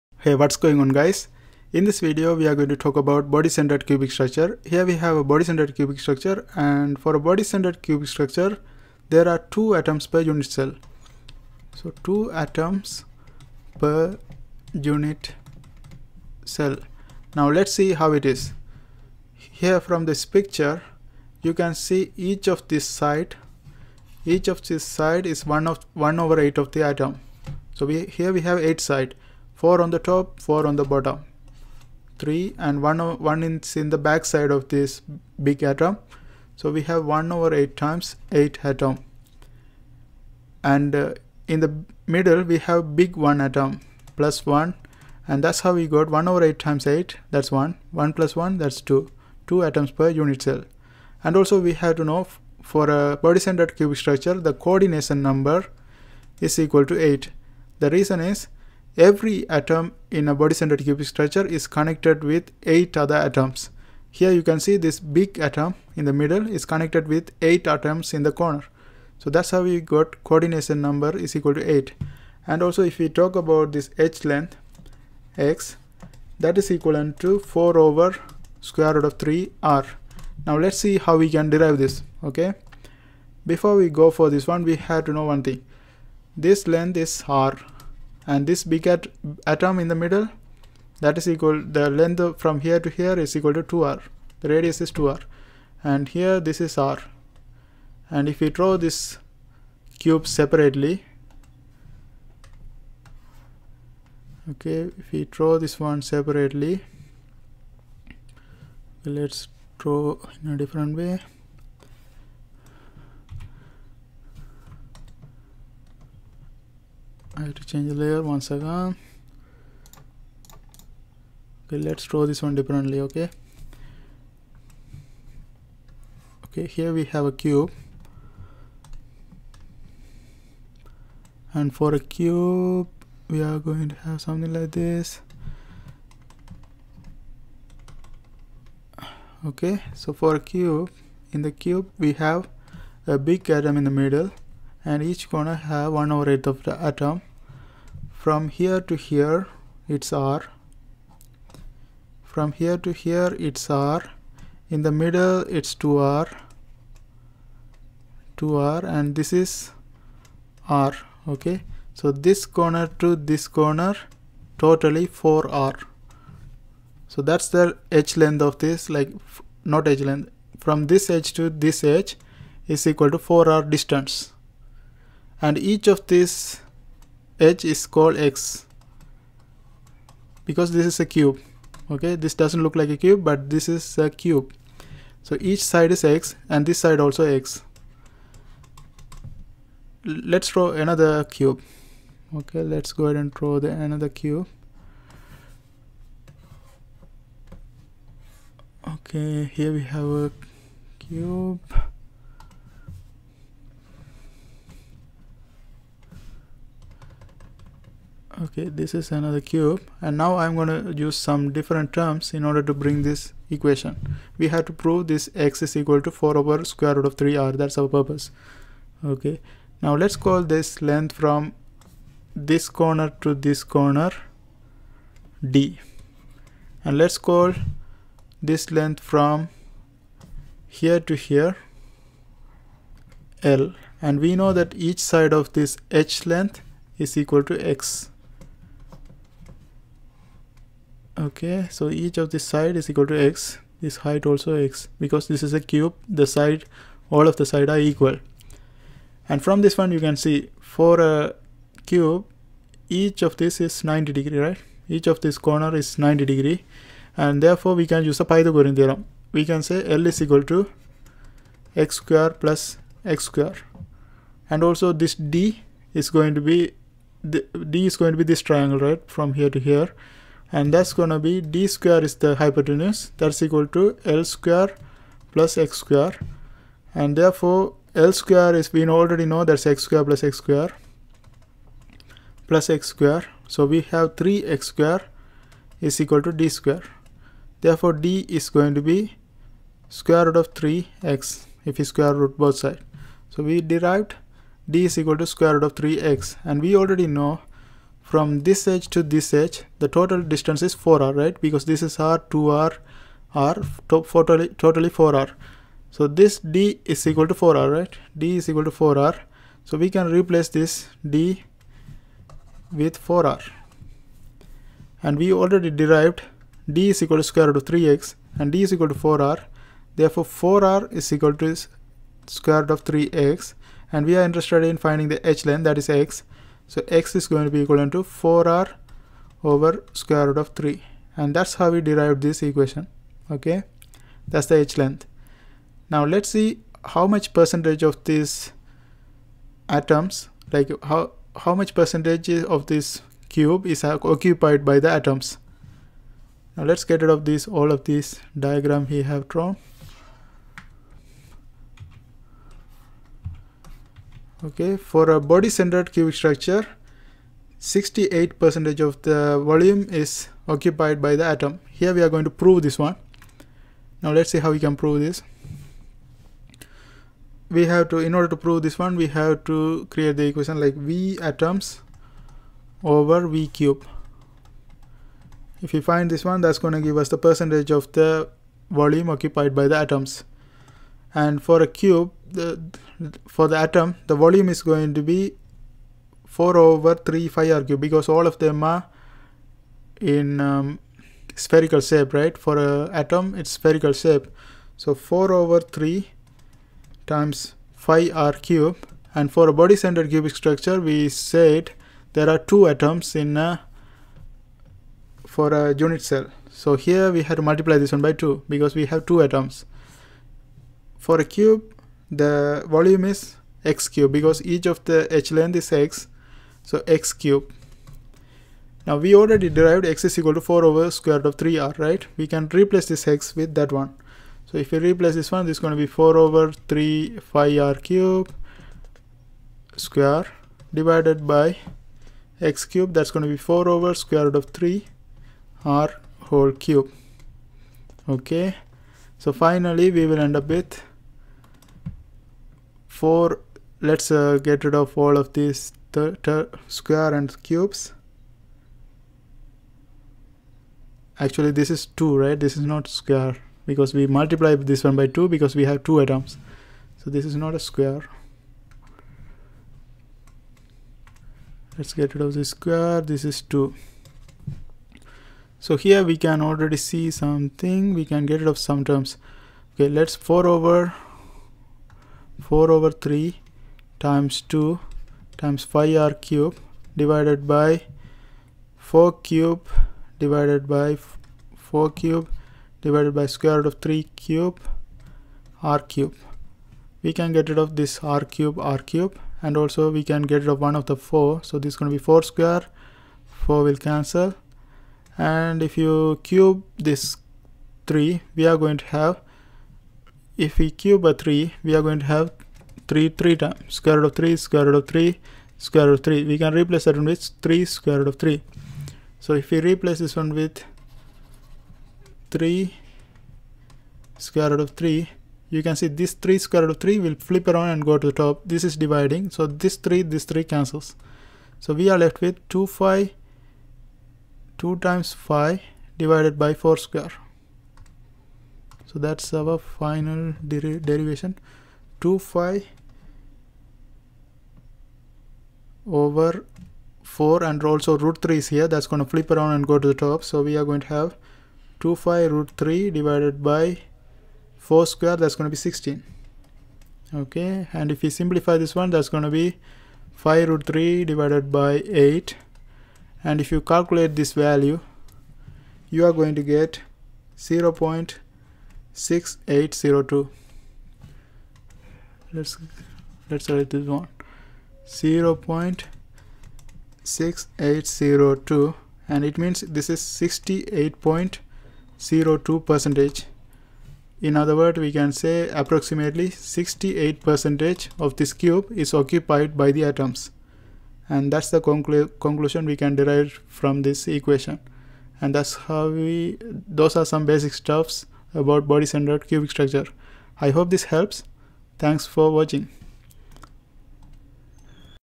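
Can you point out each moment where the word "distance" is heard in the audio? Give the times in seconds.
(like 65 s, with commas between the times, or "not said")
173 s, 300 s.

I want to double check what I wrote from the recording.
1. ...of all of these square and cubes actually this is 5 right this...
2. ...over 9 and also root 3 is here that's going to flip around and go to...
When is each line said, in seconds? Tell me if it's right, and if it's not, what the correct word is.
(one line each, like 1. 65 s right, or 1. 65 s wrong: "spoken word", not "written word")
1. 444 s wrong: "2", not "5"
2. 535 s wrong: "4", not "9".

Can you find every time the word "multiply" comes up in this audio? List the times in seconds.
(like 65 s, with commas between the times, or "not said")
407 s, 454 s.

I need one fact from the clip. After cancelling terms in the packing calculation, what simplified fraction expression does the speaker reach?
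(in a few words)
pi root 3 over 8.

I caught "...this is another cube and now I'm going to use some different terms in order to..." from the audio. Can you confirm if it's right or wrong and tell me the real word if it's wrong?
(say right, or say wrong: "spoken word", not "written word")
right.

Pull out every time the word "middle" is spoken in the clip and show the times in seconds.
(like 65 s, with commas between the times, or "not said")
42 s, 66 s, 89 s, 144 s, 154 s.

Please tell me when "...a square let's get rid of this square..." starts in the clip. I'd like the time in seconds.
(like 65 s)
457 s.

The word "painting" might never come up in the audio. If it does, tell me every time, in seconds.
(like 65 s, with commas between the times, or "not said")
not said.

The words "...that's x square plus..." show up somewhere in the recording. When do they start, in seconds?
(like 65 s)
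279 s.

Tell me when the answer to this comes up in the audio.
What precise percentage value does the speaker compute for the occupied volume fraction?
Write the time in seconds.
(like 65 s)
570 s.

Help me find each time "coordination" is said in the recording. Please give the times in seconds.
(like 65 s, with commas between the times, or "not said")
54 s, 70 s.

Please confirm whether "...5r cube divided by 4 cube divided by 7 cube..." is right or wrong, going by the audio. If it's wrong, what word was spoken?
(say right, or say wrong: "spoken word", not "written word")
wrong: "4", not "7".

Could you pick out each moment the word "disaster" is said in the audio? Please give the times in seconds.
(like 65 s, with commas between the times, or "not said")
not said.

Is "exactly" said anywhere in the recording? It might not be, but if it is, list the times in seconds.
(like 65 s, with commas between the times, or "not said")
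not said.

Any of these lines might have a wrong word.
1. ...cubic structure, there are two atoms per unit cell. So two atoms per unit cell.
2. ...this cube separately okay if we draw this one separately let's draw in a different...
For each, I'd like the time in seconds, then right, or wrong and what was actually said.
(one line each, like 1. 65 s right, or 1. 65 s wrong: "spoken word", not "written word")
1. 7 s right
2. 98 s right.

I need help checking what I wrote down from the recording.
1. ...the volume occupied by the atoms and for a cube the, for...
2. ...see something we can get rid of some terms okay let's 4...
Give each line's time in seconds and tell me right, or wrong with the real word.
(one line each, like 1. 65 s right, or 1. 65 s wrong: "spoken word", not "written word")
1. 377 s right
2. 466 s right.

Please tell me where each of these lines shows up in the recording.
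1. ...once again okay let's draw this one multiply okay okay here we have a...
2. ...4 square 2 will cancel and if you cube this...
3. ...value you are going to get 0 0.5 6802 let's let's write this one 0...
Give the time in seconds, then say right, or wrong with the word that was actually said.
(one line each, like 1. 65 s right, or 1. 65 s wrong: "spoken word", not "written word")
1. 118 s wrong: "differently", not "multiply"
2. 492 s wrong: "4", not "2"
3. 554 s right.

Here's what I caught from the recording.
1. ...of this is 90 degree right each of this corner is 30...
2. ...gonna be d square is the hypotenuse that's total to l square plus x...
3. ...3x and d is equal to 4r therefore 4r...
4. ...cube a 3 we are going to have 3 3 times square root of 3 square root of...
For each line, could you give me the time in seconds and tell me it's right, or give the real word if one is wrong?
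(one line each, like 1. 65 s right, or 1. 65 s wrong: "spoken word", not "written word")
1. 253 s wrong: "90", not "30"
2. 270 s wrong: "equal", not "total"
3. 317 s right
4. 500 s right.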